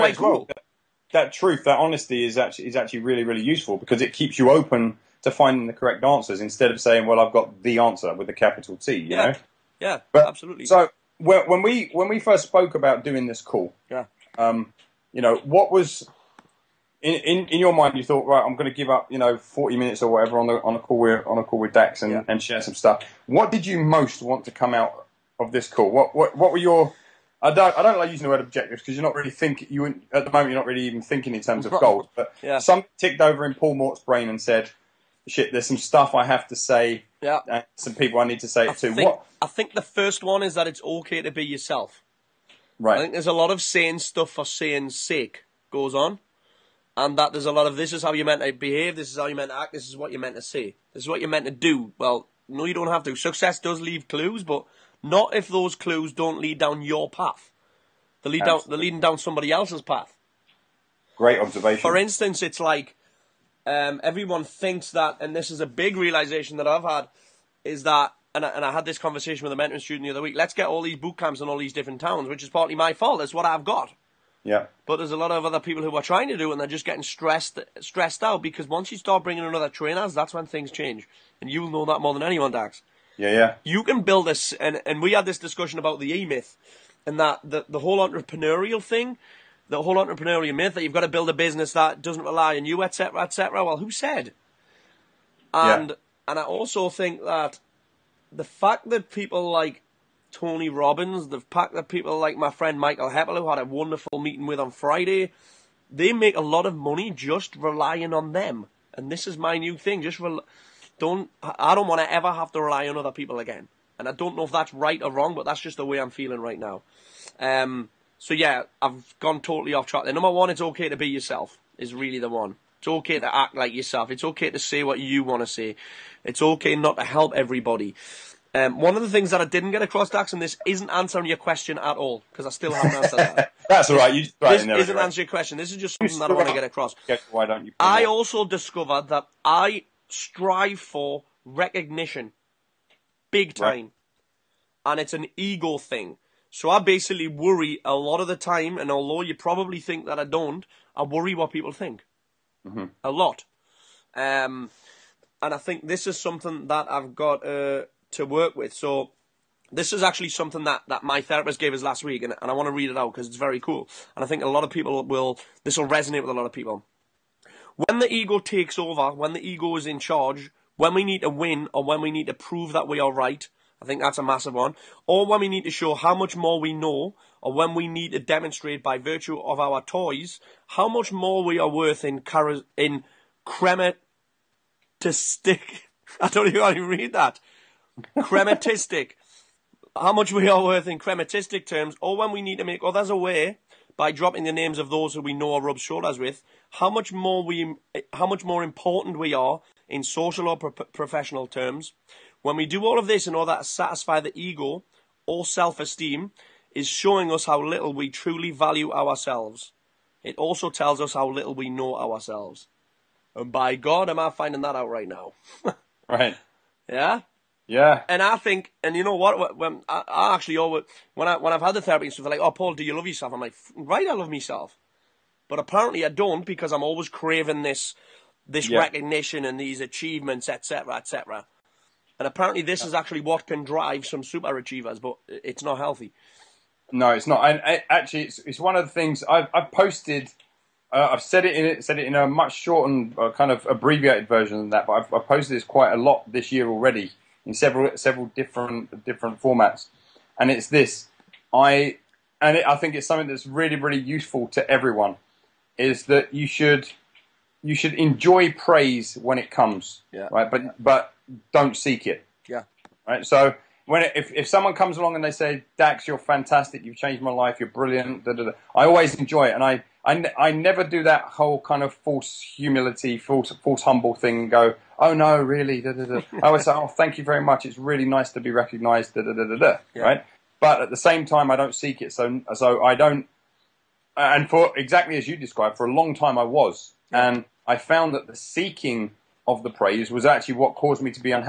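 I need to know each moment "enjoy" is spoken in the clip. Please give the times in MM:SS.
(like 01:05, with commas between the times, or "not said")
04:17, 04:29.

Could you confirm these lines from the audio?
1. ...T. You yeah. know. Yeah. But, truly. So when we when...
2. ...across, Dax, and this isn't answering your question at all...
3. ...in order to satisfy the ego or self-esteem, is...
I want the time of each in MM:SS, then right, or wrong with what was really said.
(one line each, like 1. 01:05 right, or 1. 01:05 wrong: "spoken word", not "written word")
1. 00:08 wrong: "absolutely", not "truly"
2. 02:09 right
3. 03:23 right.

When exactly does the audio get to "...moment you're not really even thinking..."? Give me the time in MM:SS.
00:30.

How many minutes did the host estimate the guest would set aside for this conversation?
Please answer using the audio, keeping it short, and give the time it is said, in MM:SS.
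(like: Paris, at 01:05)
40, at 00:19.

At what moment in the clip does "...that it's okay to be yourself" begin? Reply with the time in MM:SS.
00:40.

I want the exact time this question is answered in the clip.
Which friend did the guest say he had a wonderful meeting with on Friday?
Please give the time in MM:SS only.
01:42.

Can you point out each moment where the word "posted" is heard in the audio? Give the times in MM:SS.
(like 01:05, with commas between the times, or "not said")
03:59, 04:05.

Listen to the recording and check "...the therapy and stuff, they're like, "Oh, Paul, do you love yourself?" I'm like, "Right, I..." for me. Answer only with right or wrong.
right.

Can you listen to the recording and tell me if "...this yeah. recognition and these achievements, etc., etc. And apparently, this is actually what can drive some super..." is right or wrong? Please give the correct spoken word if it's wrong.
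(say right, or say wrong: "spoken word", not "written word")
right.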